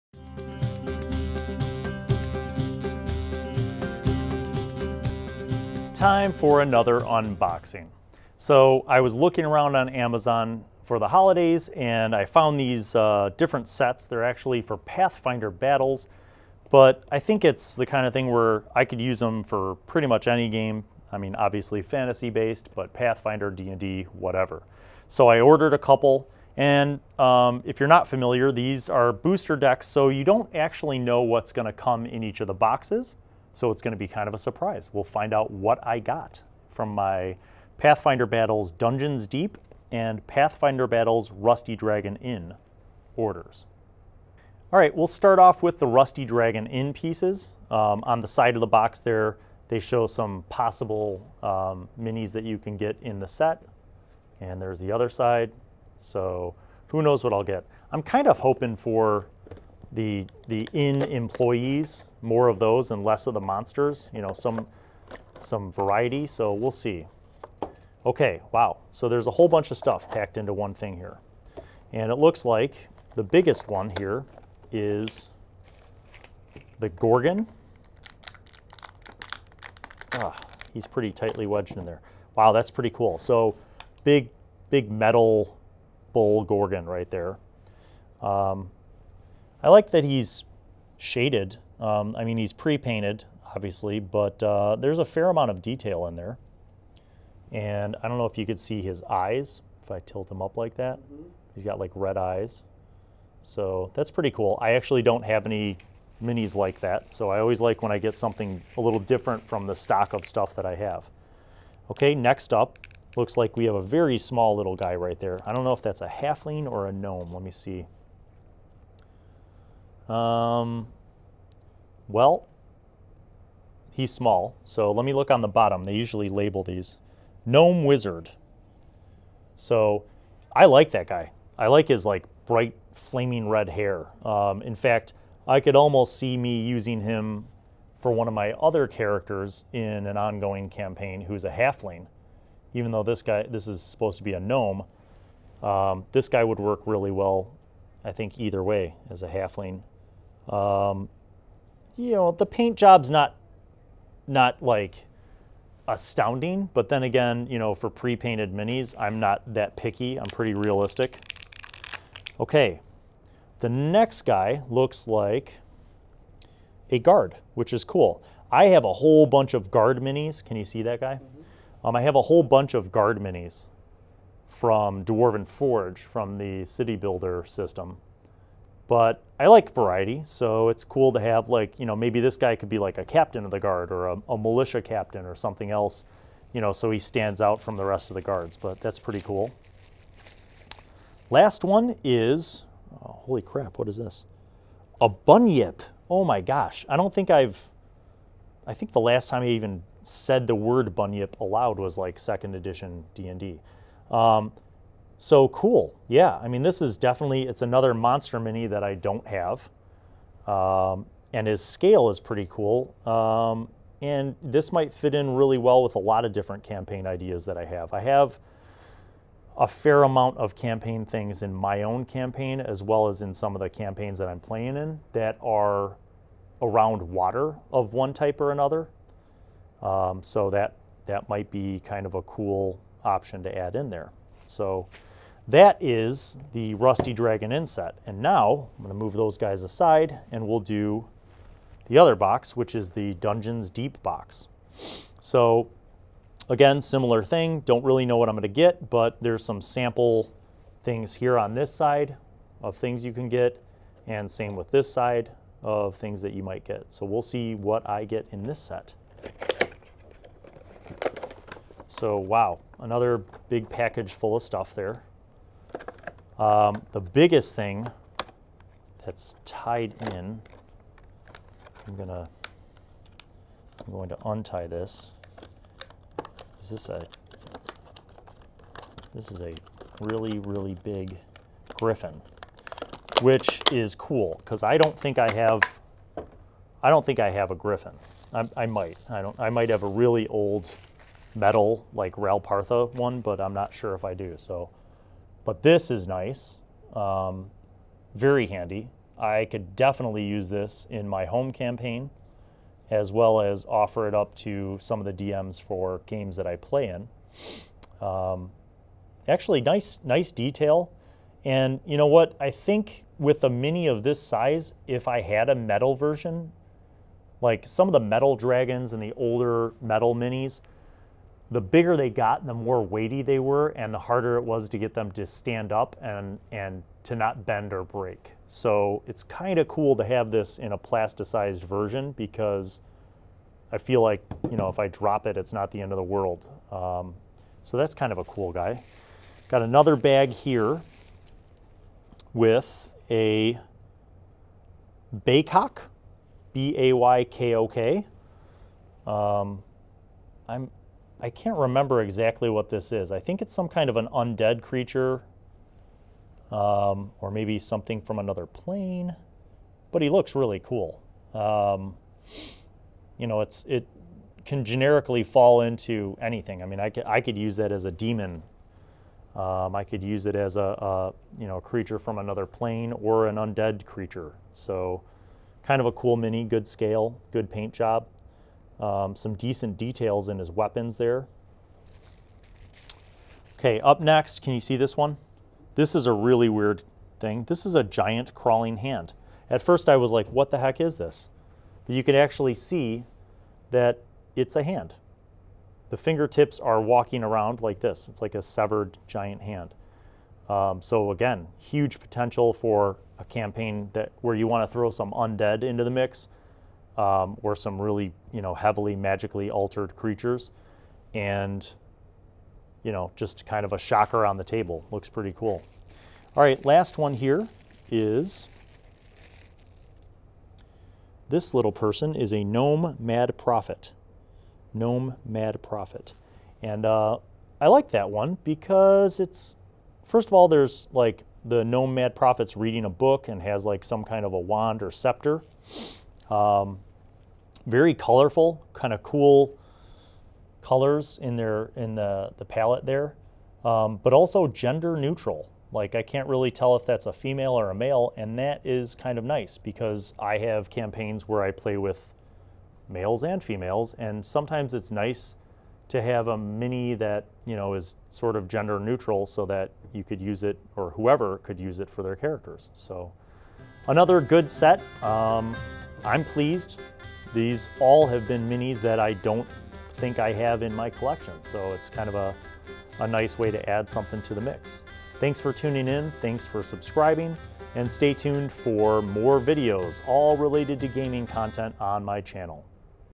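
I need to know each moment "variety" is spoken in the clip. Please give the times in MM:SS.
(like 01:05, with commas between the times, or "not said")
01:05, 02:59.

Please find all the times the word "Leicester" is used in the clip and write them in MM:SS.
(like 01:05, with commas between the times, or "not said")
not said.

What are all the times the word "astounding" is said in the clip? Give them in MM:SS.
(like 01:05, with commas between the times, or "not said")
02:35.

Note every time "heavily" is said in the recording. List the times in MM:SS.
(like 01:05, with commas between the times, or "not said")
06:48.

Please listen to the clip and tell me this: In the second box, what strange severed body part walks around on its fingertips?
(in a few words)
Giant crawling hand.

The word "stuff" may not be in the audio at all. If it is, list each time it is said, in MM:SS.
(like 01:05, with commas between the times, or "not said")
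01:09, 01:50, 04:24.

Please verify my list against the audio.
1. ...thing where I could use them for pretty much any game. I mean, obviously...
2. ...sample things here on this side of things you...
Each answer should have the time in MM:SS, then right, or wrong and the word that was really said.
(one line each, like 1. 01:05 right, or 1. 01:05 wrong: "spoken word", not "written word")
1. 00:18 right
2. 04:09 right.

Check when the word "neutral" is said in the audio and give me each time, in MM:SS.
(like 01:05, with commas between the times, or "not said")
07:24, 07:38.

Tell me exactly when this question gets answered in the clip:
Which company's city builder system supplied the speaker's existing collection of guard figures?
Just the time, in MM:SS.
02:55.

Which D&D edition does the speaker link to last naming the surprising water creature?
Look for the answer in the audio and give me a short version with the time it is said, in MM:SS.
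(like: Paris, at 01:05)
Second edition, at 03:22.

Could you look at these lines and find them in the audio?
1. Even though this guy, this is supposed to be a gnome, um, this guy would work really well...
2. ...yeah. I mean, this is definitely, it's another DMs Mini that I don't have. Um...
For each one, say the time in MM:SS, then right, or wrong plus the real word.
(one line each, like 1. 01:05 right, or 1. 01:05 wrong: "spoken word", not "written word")
1. 02:22 right
2. 03:26 wrong: "Monster", not "DMs".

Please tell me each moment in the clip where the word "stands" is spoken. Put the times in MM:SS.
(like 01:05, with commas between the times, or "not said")
03:06, 05:25.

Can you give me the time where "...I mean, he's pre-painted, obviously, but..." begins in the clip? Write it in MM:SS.
01:32.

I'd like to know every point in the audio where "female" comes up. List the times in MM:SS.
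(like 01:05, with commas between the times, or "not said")
07:27, 07:33.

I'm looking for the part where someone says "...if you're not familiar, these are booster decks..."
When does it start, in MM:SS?
00:27.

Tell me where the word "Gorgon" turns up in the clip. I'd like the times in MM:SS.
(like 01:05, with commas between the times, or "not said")
01:16, 01:26.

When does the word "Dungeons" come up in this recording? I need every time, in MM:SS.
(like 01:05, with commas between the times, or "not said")
00:38, 04:03.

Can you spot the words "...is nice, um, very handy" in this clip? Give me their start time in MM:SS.
04:55.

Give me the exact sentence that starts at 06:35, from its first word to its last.
The fingertips are walking around like this.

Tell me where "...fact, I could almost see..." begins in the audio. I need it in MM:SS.
02:14.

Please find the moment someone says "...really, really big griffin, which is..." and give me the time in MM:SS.
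04:39.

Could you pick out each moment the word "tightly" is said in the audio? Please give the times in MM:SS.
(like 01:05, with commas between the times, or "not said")
01:21.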